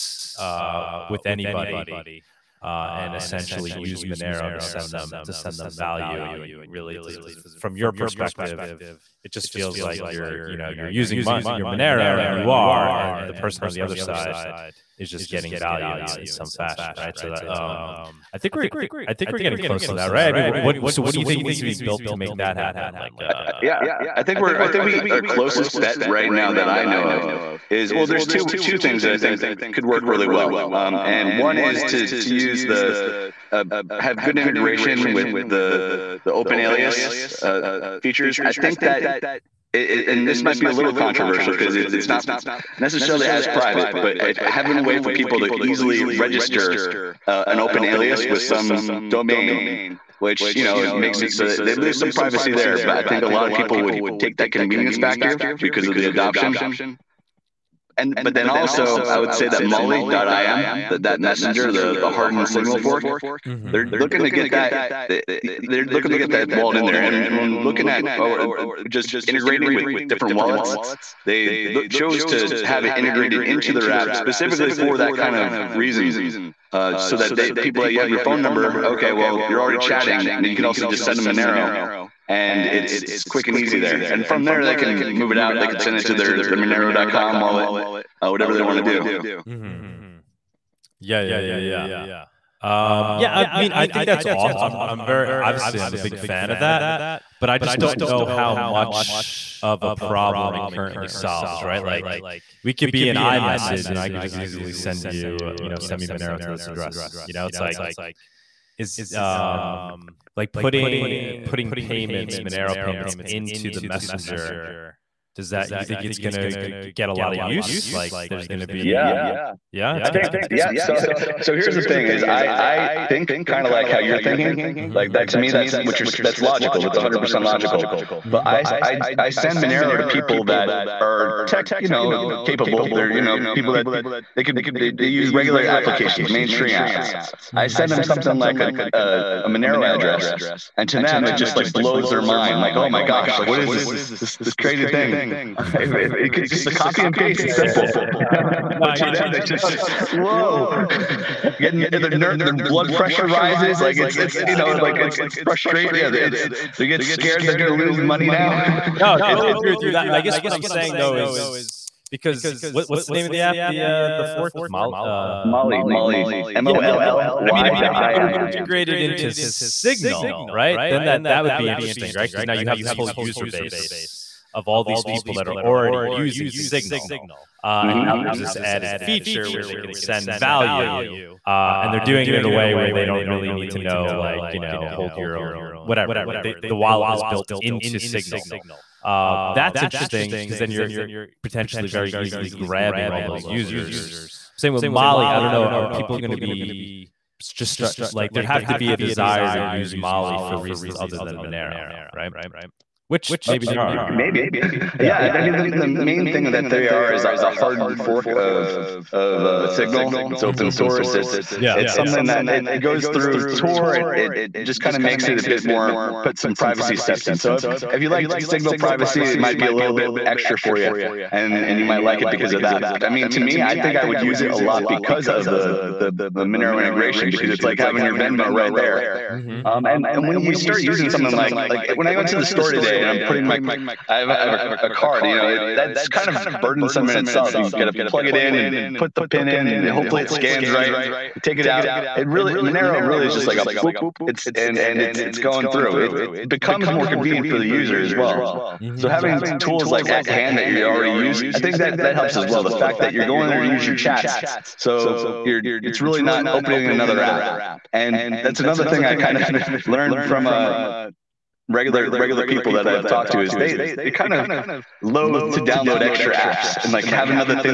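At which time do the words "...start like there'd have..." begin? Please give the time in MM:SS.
03:17.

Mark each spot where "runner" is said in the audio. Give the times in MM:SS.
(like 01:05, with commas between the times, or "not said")
not said.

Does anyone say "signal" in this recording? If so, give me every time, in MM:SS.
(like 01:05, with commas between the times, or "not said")
01:02, 02:49, 02:56, 03:08, 03:29, 03:38.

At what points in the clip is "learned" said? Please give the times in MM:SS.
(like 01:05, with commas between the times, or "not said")
04:19.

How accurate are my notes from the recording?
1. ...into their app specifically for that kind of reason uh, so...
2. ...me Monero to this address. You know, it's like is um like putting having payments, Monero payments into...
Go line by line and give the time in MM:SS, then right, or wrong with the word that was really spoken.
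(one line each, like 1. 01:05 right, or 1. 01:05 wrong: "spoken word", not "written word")
1. 01:13 right
2. 01:46 wrong: "putting", not "having".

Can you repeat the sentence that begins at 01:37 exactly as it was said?
don't know how much of a problem it currently solves, right?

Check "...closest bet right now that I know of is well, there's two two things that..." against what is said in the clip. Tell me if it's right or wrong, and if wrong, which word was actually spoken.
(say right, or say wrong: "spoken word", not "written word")
right.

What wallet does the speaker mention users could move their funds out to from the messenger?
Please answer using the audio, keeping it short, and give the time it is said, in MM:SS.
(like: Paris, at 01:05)
Monero.com, at 01:26.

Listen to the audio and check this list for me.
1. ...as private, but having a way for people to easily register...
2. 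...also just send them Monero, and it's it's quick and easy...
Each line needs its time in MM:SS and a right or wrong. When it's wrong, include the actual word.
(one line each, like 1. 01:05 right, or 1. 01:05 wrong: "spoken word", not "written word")
1. 00:43 right
2. 01:20 right.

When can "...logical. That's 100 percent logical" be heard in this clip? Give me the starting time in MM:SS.
02:06.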